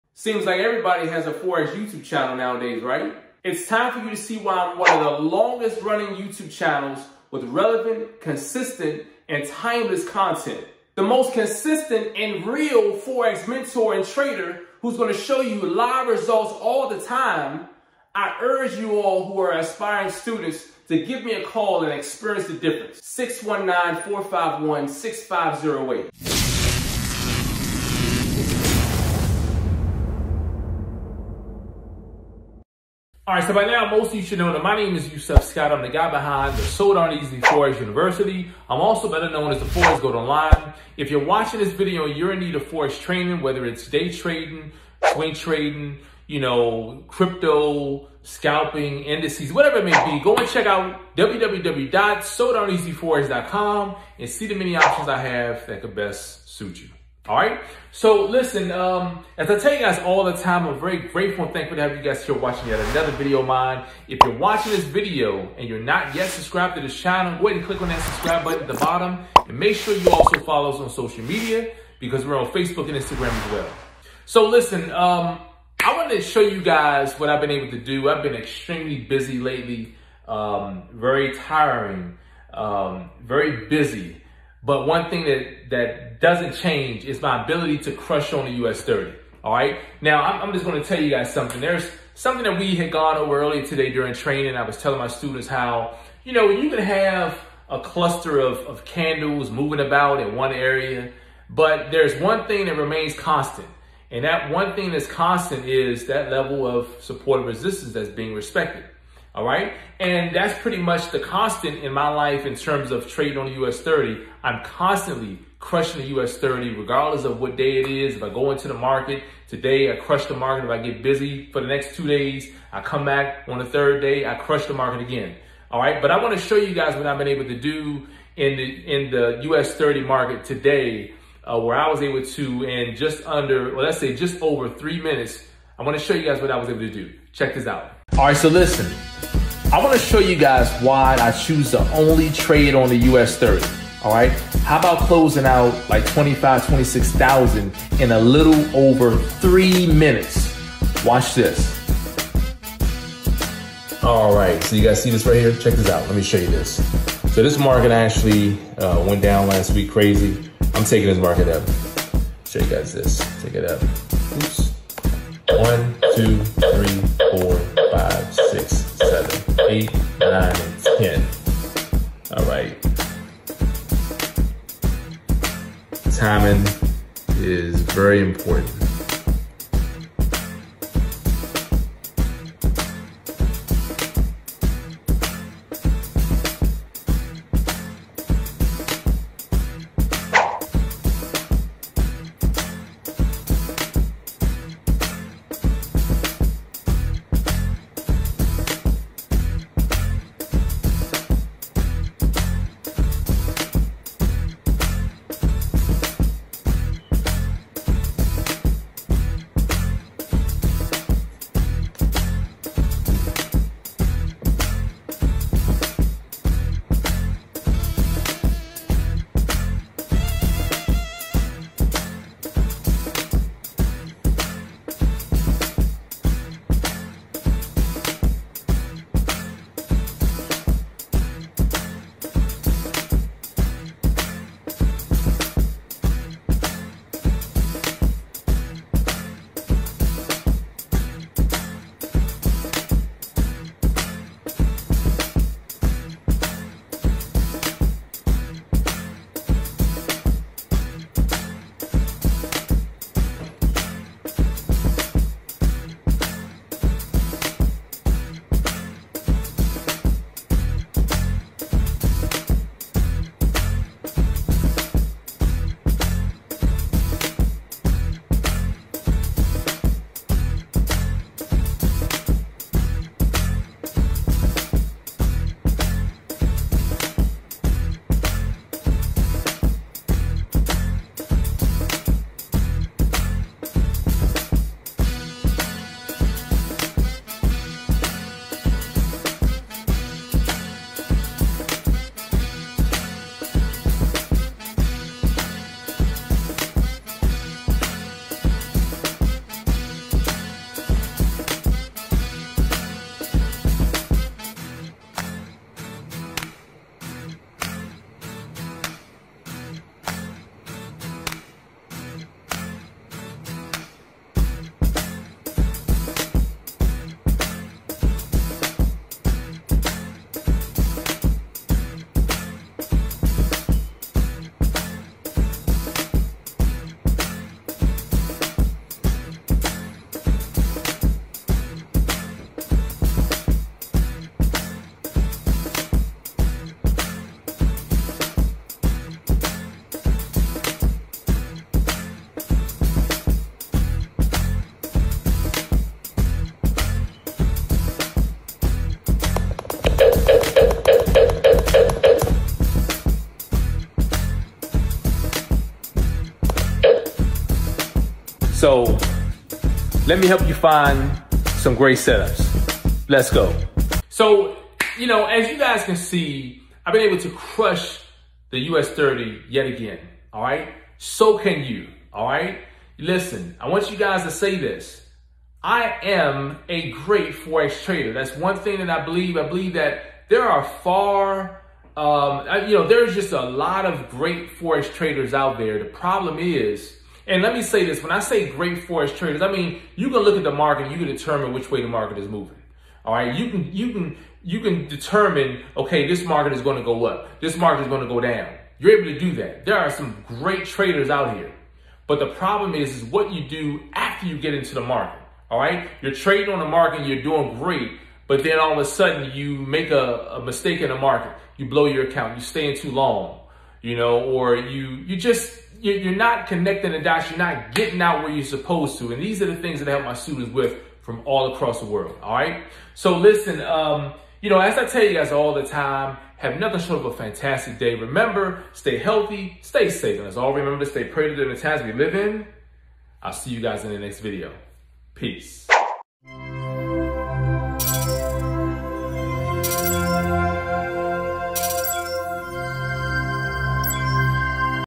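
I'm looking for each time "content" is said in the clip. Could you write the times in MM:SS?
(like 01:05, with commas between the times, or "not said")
00:10.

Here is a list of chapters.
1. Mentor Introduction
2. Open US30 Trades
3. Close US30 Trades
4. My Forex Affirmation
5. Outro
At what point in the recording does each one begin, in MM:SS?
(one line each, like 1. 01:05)
1. 00:33
2. 02:44
3. 05:48
4. 06:15
5. 07:15.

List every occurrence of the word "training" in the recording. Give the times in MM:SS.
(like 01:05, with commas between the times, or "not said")
00:42, 01:34.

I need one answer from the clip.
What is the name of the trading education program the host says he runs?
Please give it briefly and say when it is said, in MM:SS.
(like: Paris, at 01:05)
So Darn Easy Forex University, at 00:36.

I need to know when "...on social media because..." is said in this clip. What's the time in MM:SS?
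01:10.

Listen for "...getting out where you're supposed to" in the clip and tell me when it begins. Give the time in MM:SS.
06:57.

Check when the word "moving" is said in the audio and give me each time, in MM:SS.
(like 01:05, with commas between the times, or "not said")
01:39, 06:32.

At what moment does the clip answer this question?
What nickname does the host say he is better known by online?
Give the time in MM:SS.
00:39.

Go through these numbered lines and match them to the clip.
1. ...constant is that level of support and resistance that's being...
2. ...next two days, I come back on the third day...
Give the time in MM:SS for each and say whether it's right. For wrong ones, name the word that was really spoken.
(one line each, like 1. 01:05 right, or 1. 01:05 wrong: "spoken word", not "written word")
1. 01:45 right
2. 02:01 right.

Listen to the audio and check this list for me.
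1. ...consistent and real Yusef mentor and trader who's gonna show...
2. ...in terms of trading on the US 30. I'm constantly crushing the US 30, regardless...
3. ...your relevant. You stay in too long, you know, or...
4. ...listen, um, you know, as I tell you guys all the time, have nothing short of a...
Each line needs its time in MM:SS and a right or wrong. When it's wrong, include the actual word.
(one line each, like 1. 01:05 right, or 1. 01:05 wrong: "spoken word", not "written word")
1. 00:11 wrong: "Forex", not "Yusef"
2. 01:52 right
3. 06:51 wrong: "account", not "relevant"
4. 07:03 right.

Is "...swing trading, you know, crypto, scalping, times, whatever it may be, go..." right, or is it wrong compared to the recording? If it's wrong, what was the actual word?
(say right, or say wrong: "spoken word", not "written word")
wrong: "indices", not "times".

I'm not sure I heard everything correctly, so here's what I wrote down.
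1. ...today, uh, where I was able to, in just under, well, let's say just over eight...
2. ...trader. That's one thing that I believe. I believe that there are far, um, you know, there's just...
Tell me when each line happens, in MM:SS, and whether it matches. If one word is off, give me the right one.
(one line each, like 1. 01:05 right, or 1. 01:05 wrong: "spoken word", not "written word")
1. 02:10 wrong: "three", not "eight"
2. 06:17 right.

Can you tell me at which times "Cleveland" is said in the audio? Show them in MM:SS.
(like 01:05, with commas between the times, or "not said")
not said.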